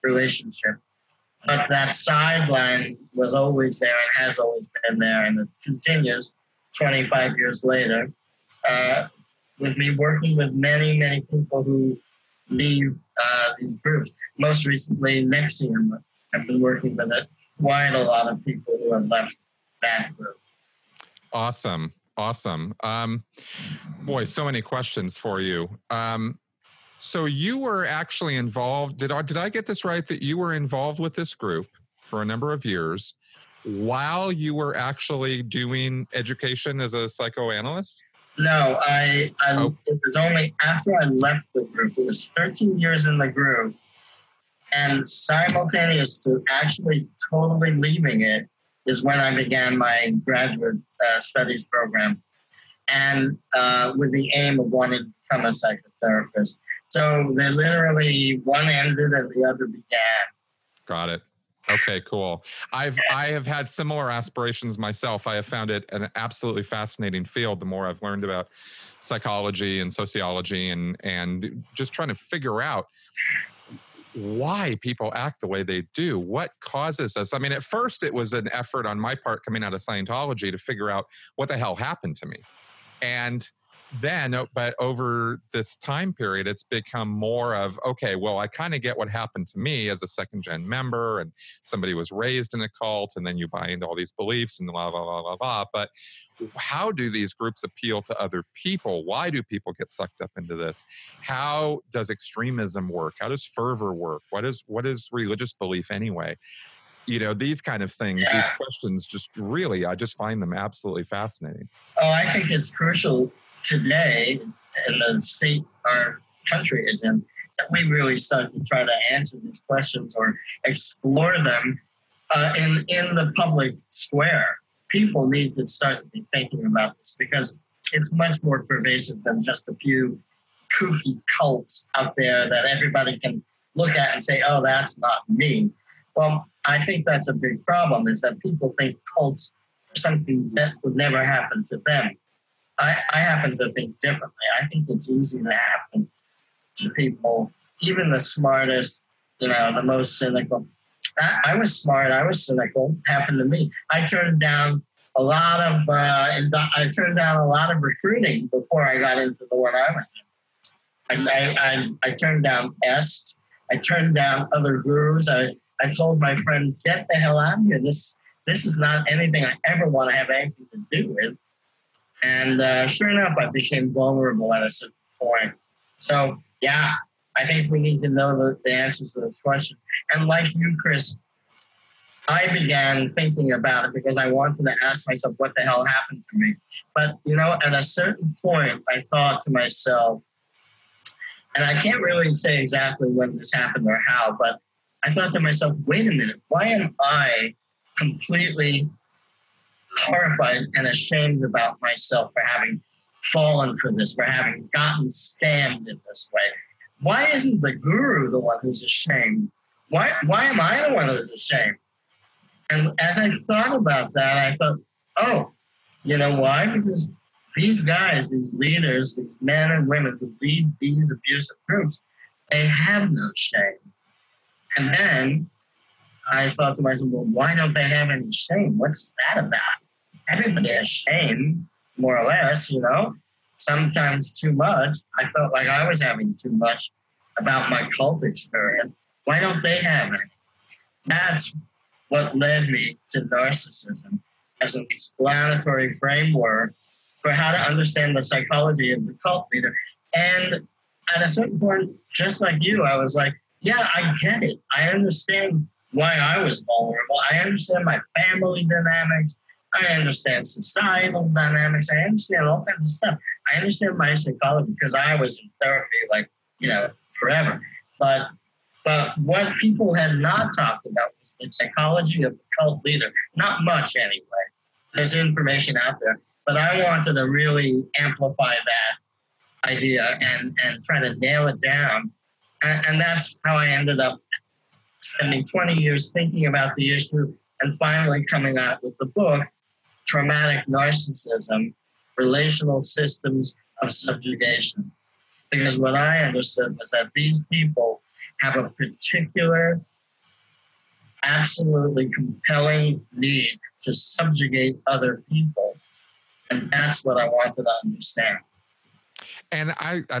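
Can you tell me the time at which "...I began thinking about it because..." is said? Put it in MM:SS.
03:02.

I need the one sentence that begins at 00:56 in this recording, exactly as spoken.
So they literally one ended and the other began.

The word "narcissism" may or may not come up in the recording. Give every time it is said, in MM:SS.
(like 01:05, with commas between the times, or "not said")
04:03, 04:50.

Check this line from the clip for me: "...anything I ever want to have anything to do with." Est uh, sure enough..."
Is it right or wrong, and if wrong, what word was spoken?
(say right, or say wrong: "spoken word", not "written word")
wrong: "And", not "Est".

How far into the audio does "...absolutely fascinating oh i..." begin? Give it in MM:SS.
01:50.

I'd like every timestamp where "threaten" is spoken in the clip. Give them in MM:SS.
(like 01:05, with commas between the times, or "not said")
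not said.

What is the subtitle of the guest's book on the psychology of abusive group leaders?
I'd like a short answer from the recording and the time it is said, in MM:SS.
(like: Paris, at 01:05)
Relational Systems of Subjugation, at 04:52.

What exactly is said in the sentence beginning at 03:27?
Why isn't the guru the one who's ashamed?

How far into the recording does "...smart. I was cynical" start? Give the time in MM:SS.
02:31.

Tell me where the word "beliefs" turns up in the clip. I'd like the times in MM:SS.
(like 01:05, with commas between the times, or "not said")
01:34, 01:45.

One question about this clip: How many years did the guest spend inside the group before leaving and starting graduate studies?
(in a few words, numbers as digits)
13.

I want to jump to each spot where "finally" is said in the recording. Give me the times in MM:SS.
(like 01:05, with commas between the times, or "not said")
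04:47.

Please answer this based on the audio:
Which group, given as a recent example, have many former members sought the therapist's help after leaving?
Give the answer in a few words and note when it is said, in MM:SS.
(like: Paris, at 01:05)
NXIVM, at 00:15.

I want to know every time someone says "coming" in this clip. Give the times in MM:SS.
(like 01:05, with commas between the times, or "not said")
01:19, 04:48.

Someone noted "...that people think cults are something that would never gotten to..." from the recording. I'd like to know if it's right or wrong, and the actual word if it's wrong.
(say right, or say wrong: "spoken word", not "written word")
wrong: "happen", not "gotten".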